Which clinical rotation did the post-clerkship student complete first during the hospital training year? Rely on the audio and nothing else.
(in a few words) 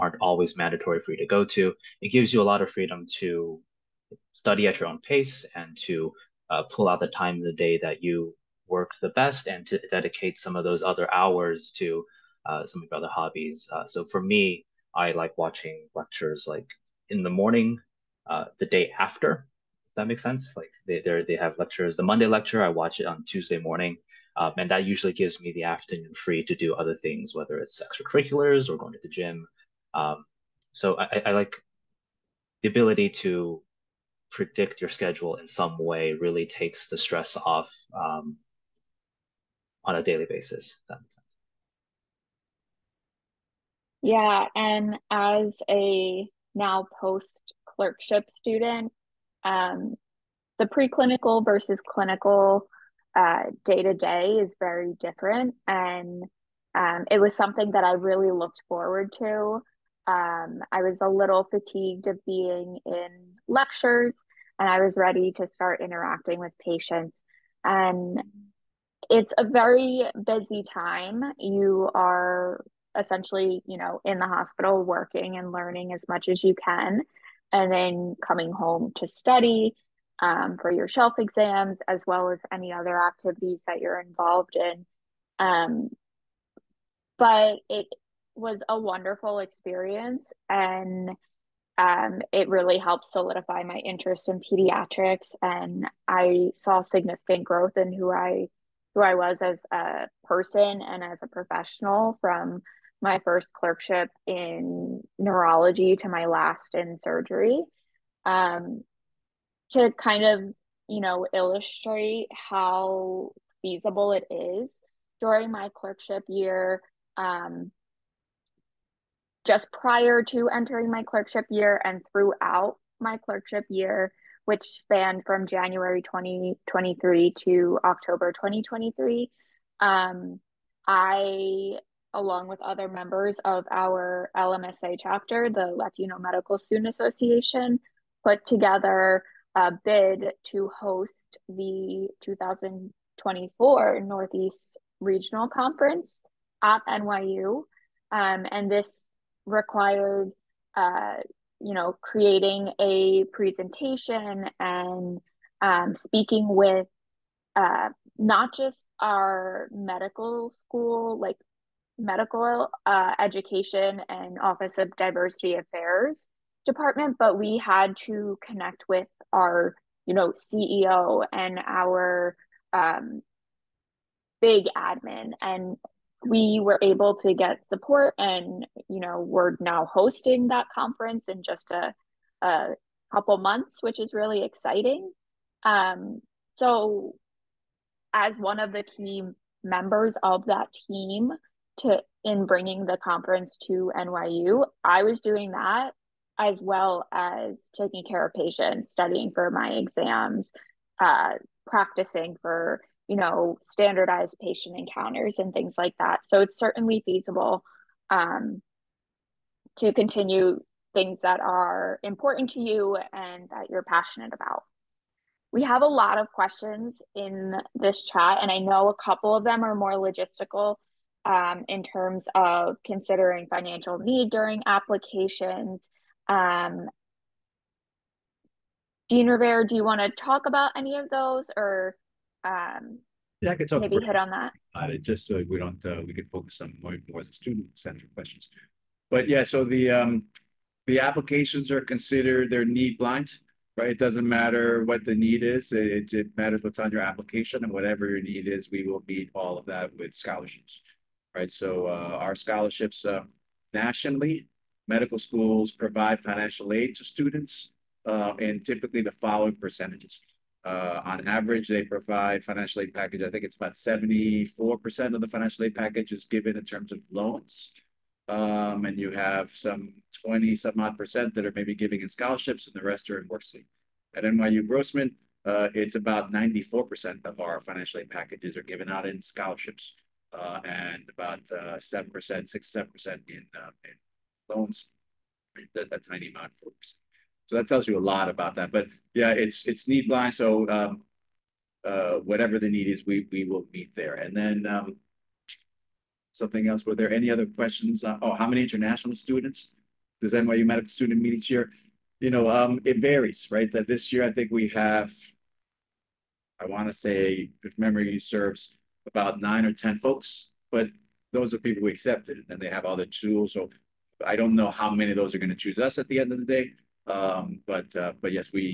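Neurology.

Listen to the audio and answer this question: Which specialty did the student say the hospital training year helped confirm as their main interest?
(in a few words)
Pediatrics.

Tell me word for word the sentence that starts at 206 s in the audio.
So it's certainly feasible um, to continue things that are important to you and that you're passionate about.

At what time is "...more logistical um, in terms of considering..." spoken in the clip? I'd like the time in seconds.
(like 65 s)
219 s.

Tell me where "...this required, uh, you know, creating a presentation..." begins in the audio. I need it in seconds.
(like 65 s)
148 s.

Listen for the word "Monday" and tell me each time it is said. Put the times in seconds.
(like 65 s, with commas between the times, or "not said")
22 s.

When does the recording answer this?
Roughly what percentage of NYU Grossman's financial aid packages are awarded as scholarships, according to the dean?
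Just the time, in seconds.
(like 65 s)
276 s.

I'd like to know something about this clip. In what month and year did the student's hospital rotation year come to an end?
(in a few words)
October 2023.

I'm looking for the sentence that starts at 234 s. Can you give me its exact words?
It, just so we don't, uh, we could focus on more, more the student-centered questions.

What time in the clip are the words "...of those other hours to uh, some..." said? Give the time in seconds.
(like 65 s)
10 s.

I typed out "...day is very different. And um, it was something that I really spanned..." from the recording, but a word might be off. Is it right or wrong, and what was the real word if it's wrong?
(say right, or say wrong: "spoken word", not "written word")
wrong: "looked", not "spanned".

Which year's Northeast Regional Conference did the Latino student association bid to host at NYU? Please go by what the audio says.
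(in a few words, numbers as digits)
2024.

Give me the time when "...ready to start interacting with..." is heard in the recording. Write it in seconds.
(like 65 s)
64 s.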